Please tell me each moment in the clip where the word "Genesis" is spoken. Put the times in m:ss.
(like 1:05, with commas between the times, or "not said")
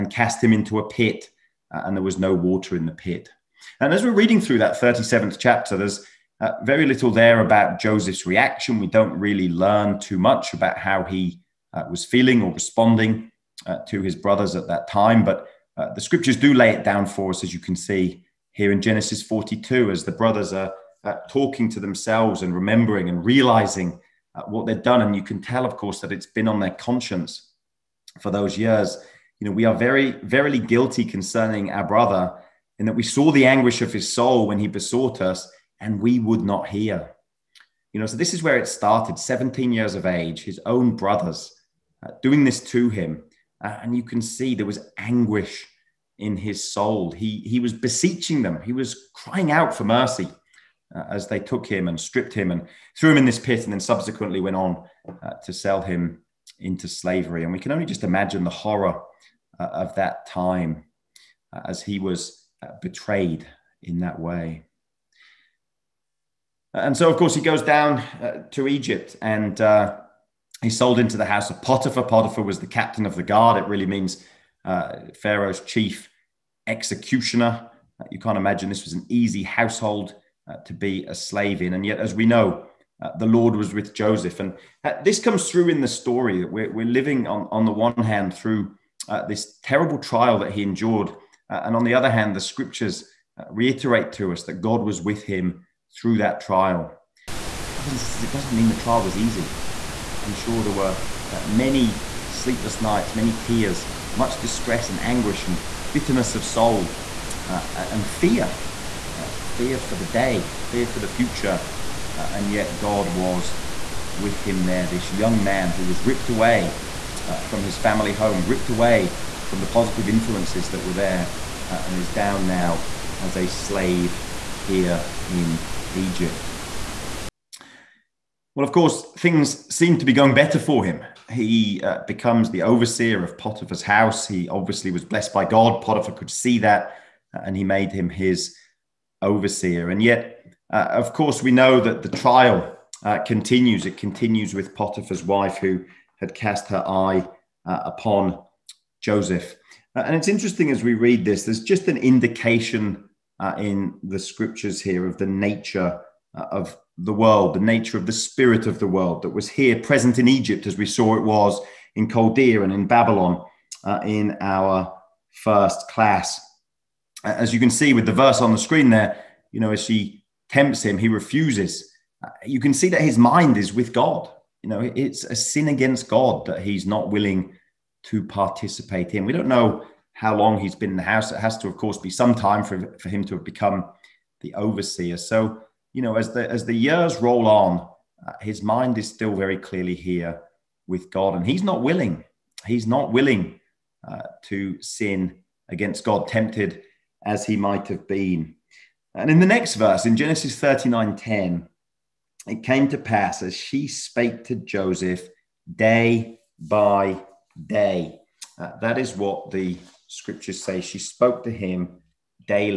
0:18, 3:20.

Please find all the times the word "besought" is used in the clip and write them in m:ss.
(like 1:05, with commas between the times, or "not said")
0:34.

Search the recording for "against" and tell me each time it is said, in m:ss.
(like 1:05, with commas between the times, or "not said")
2:55, 3:15.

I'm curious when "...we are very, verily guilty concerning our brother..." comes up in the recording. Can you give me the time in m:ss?
0:29.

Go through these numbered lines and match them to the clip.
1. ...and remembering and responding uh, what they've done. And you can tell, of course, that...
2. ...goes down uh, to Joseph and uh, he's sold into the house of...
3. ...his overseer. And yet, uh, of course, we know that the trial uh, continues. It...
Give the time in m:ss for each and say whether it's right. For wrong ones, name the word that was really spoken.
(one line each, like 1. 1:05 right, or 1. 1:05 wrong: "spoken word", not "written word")
1. 0:22 wrong: "realizing", not "responding"
2. 1:07 wrong: "Egypt", not "Joseph"
3. 2:18 right.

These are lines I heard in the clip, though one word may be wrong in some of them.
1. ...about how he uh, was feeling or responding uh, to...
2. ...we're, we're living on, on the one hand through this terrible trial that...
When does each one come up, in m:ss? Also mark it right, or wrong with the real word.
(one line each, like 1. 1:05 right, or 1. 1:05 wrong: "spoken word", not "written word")
1. 0:10 right
2. 1:26 right.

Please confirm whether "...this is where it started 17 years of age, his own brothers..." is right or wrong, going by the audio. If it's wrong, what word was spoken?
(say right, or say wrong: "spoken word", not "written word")
right.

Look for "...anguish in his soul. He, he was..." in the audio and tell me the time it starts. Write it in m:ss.
0:44.